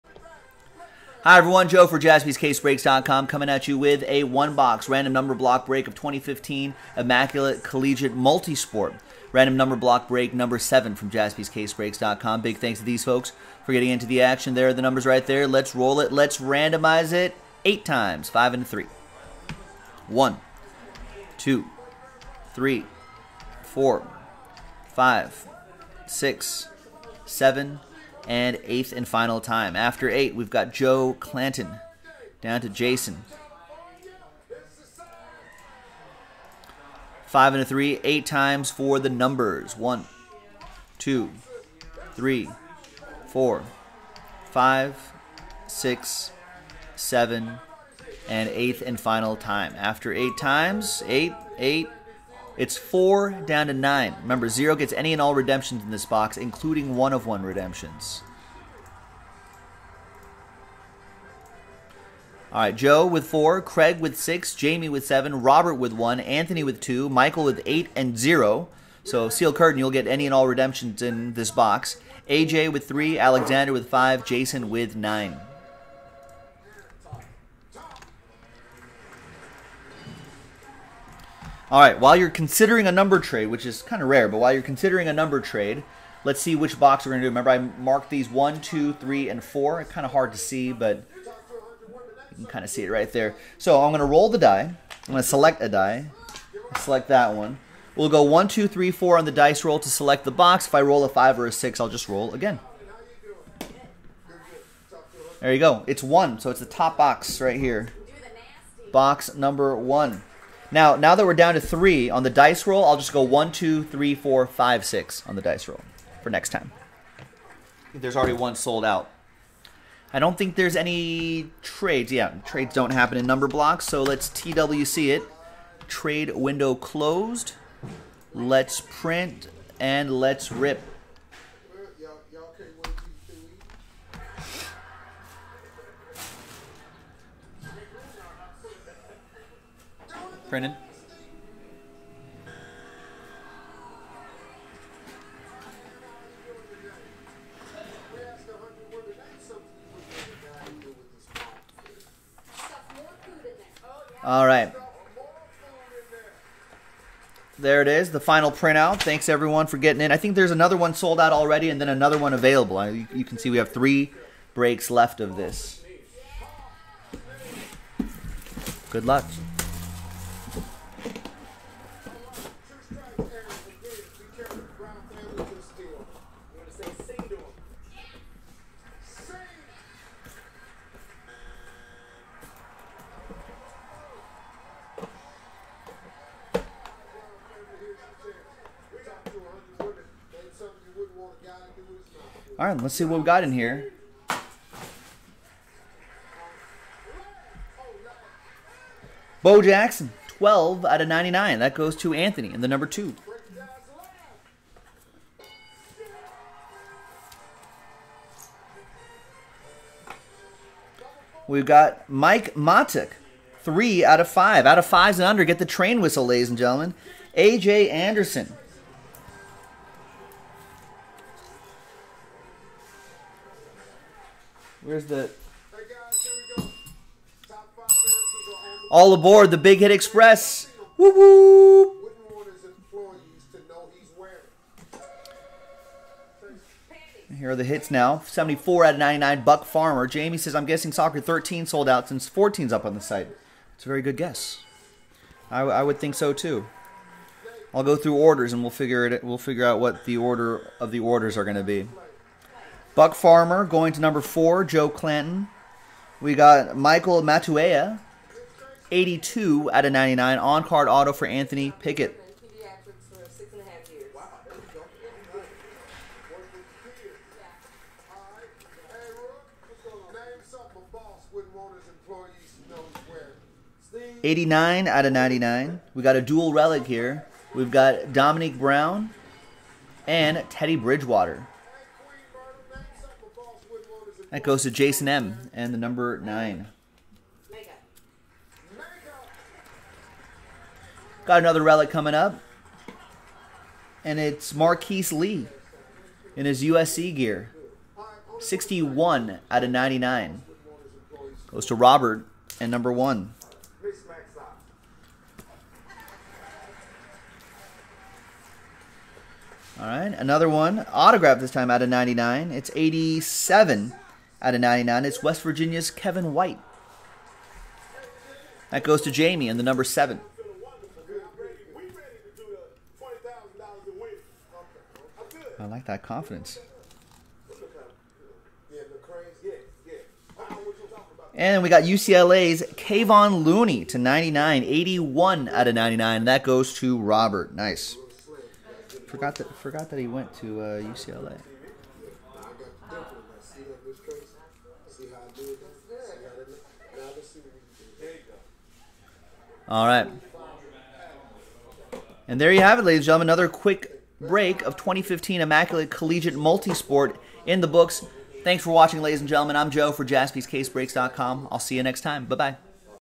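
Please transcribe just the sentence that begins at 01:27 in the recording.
Remember, I marked these one, two, three, and 4.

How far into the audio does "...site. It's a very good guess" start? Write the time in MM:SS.
04:03.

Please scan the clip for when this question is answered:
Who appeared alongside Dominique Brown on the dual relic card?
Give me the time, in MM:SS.
04:40.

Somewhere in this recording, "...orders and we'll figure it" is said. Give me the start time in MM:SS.
04:08.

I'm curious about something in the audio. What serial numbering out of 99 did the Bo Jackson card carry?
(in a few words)
12.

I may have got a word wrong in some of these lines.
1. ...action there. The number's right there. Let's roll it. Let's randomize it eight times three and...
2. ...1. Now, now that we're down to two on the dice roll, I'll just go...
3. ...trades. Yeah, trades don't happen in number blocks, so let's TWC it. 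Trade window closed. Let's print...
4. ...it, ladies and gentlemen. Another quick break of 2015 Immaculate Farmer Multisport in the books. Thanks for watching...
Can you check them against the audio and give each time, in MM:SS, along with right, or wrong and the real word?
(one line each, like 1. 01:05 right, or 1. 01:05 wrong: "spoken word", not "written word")
1. 00:14 wrong: "five", not "three"
2. 01:49 wrong: "three", not "two"
3. 02:01 right
4. 05:52 wrong: "Collegiate", not "Farmer".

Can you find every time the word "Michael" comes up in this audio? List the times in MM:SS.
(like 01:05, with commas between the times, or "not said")
01:07, 04:16.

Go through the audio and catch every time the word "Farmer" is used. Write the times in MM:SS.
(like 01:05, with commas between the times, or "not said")
03:59, 04:13.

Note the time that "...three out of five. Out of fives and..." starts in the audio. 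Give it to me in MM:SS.
03:33.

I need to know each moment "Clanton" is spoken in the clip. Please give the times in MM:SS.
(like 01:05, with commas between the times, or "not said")
00:31, 04:14.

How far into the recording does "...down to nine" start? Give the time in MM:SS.
00:53.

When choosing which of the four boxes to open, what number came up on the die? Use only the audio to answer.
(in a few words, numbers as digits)
1.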